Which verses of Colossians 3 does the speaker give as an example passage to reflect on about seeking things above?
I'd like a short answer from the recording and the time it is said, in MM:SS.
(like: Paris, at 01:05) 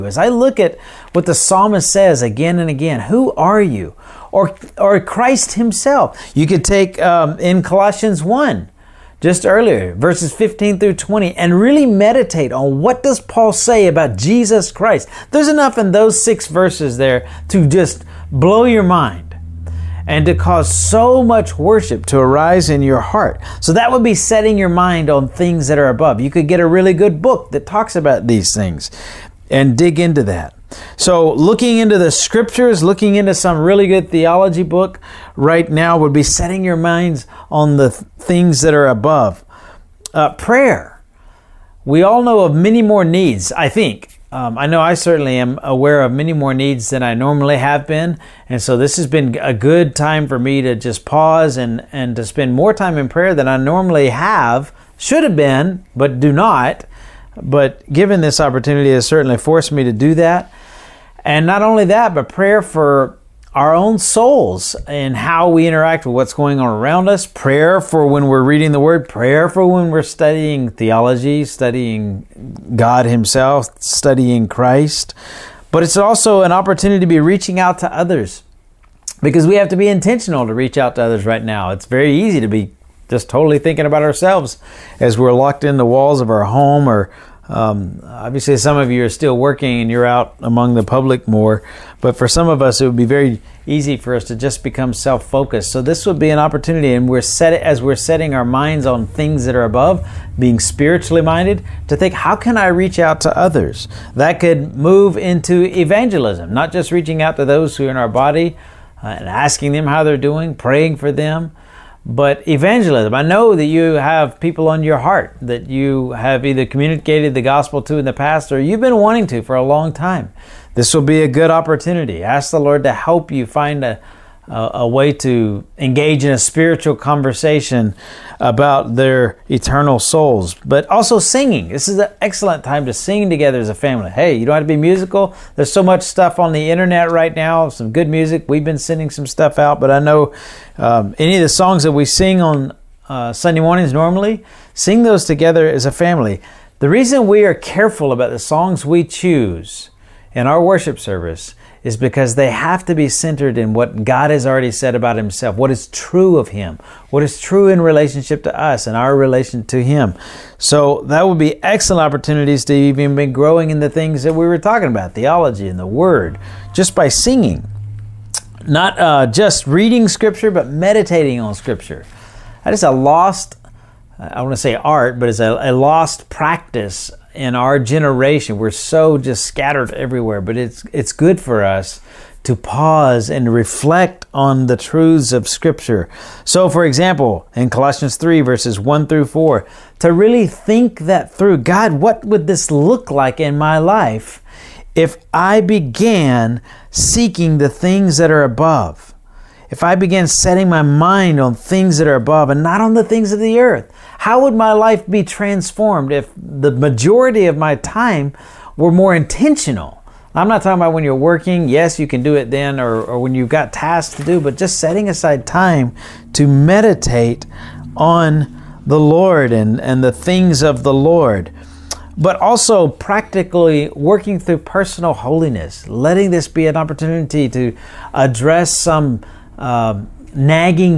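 1 through 4, at 03:08.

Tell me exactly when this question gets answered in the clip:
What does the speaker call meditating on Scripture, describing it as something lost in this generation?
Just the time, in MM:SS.
02:55.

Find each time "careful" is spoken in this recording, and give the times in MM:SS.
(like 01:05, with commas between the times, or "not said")
02:27.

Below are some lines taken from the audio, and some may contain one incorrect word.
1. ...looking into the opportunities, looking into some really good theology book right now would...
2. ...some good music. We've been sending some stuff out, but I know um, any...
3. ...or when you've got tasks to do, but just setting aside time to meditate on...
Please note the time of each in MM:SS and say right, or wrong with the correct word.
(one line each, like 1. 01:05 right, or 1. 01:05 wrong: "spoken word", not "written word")
1. 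00:31 wrong: "scriptures", not "opportunities"
2. 02:17 right
3. 03:33 right.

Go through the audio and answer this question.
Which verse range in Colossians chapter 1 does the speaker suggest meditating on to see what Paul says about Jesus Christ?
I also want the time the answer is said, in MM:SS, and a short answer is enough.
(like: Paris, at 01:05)
15 through 20, at 00:09.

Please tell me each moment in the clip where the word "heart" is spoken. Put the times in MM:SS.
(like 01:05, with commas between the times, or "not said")
00:22, 01:54.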